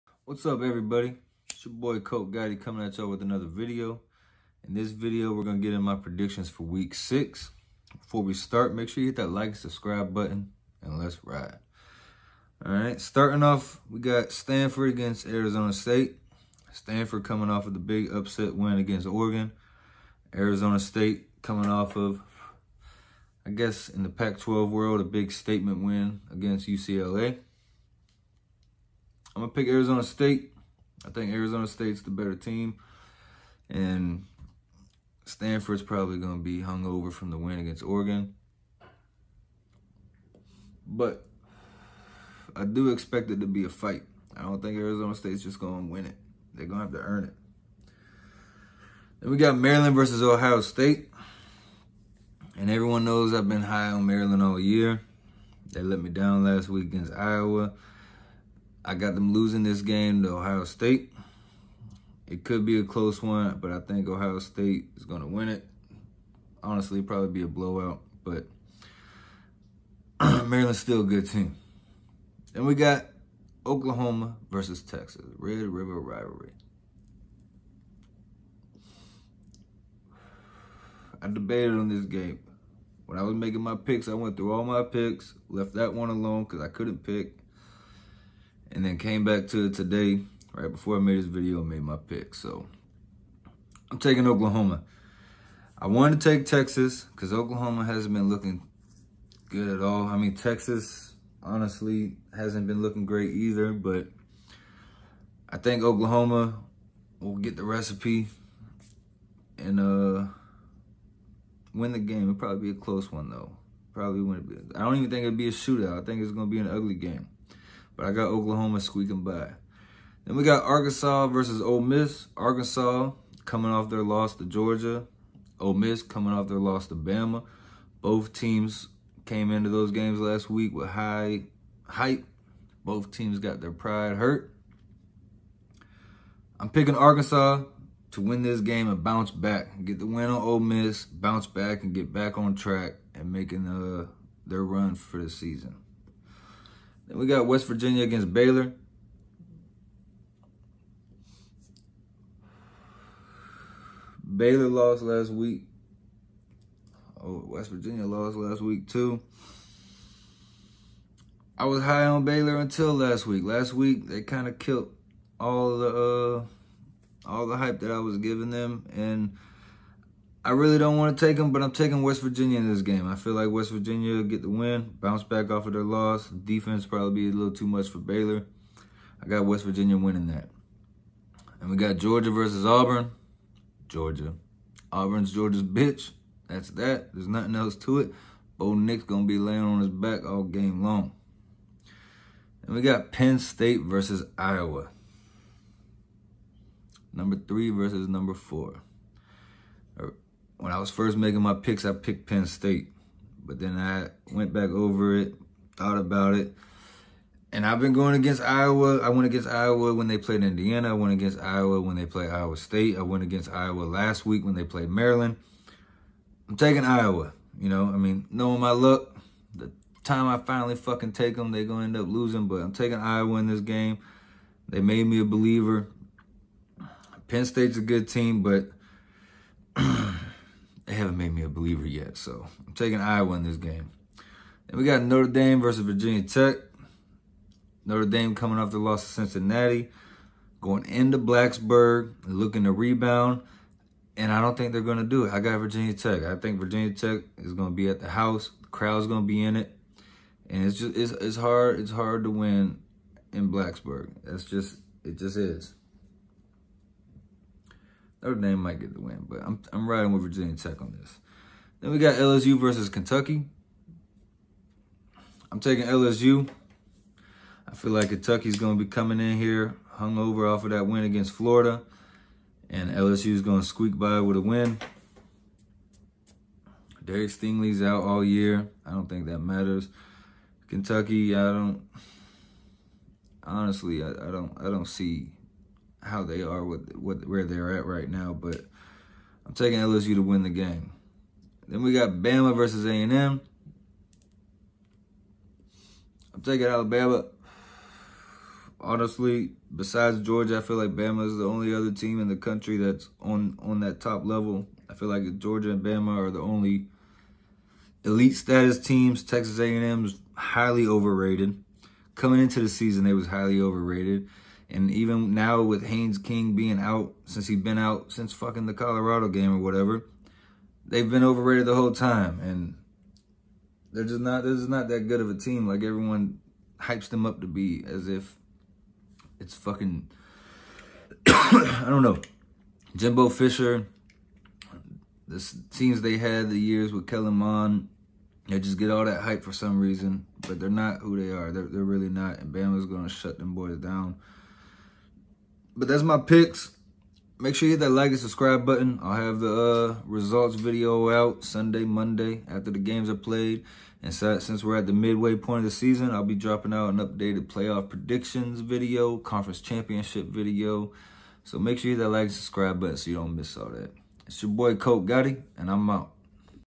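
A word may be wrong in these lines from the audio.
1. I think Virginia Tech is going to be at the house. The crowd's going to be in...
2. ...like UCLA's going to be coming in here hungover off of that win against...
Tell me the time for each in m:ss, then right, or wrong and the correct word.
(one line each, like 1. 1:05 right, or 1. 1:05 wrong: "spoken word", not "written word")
1. 4:06 right
2. 4:27 wrong: "Kentucky", not "UCLA".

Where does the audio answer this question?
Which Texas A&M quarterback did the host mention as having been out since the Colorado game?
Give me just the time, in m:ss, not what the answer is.
5:15.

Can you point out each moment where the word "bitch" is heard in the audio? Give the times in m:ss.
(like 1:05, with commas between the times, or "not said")
3:05.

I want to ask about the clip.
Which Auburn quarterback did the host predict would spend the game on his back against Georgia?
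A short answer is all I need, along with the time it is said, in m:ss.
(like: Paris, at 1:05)
Bo Nix, at 3:08.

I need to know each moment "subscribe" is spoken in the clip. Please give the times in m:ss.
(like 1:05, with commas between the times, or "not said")
0:09, 5:48, 6:02.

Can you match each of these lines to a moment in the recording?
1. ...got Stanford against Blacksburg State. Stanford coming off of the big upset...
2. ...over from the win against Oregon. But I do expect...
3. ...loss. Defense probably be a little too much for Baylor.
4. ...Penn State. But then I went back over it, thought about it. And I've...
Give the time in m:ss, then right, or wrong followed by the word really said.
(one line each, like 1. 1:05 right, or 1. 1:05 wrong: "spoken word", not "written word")
1. 0:13 wrong: "Arizona", not "Blacksburg"
2. 0:36 right
3. 2:55 right
4. 3:22 right.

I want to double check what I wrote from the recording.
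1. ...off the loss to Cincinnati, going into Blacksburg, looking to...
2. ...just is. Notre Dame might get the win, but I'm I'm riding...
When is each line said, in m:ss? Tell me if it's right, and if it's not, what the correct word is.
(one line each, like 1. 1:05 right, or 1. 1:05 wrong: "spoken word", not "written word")
1. 3:58 right
2. 4:15 right.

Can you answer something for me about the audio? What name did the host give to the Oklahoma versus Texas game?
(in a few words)
Red River rivalry.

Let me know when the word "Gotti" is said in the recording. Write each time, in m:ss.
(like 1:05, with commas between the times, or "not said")
0:02, 6:05.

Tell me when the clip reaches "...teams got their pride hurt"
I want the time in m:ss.
2:13.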